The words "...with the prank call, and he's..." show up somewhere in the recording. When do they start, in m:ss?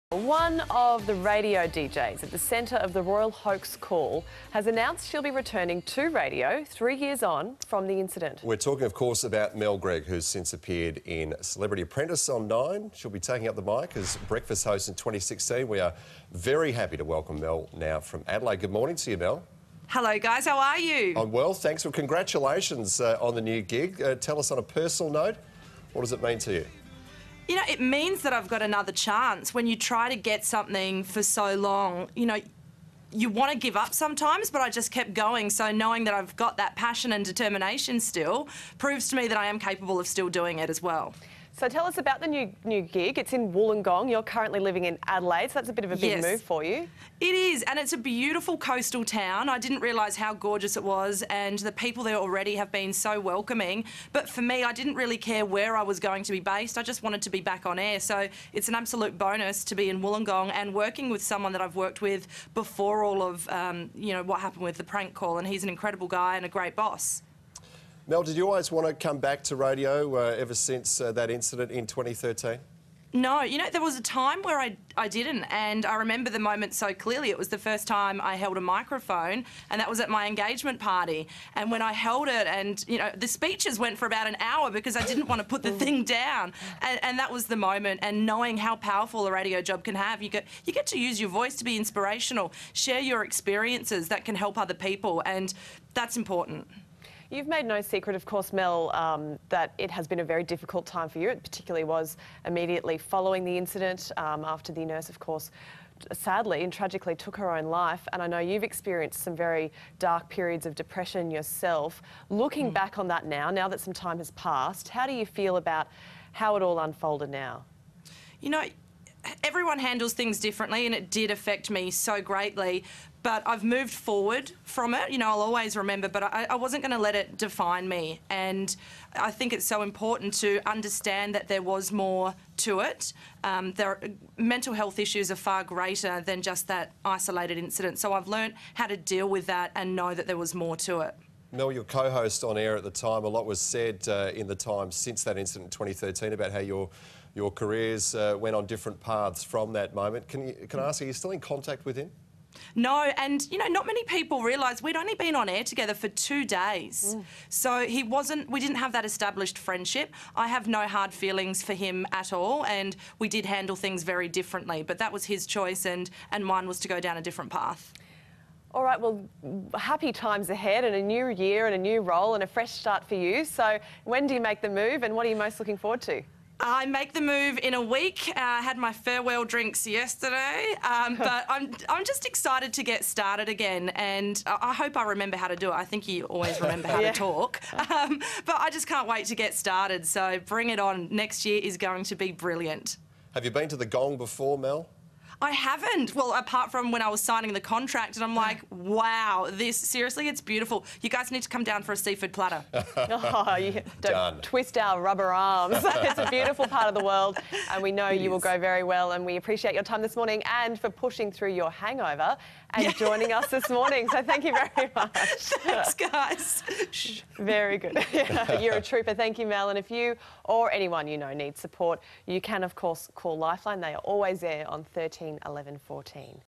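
1:04.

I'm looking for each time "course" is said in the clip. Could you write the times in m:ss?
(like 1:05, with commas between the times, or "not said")
0:08, 1:38, 1:45, 3:42.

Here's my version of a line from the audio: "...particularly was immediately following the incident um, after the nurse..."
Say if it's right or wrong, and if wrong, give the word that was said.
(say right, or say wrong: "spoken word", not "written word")
right.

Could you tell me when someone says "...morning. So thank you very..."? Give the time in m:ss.
3:33.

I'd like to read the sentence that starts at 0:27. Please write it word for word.
you know, it means that I've got another chance.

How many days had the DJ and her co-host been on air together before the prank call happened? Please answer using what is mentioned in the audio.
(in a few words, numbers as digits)
2.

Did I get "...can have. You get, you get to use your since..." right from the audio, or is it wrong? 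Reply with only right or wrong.
wrong.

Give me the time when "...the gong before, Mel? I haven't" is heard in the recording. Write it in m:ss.
3:13.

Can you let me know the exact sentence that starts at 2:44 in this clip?
But that was his choice, and, and mine was to go down a different path.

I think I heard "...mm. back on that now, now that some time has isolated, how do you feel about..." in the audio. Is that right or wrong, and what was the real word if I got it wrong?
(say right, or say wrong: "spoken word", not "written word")
wrong: "passed", not "isolated".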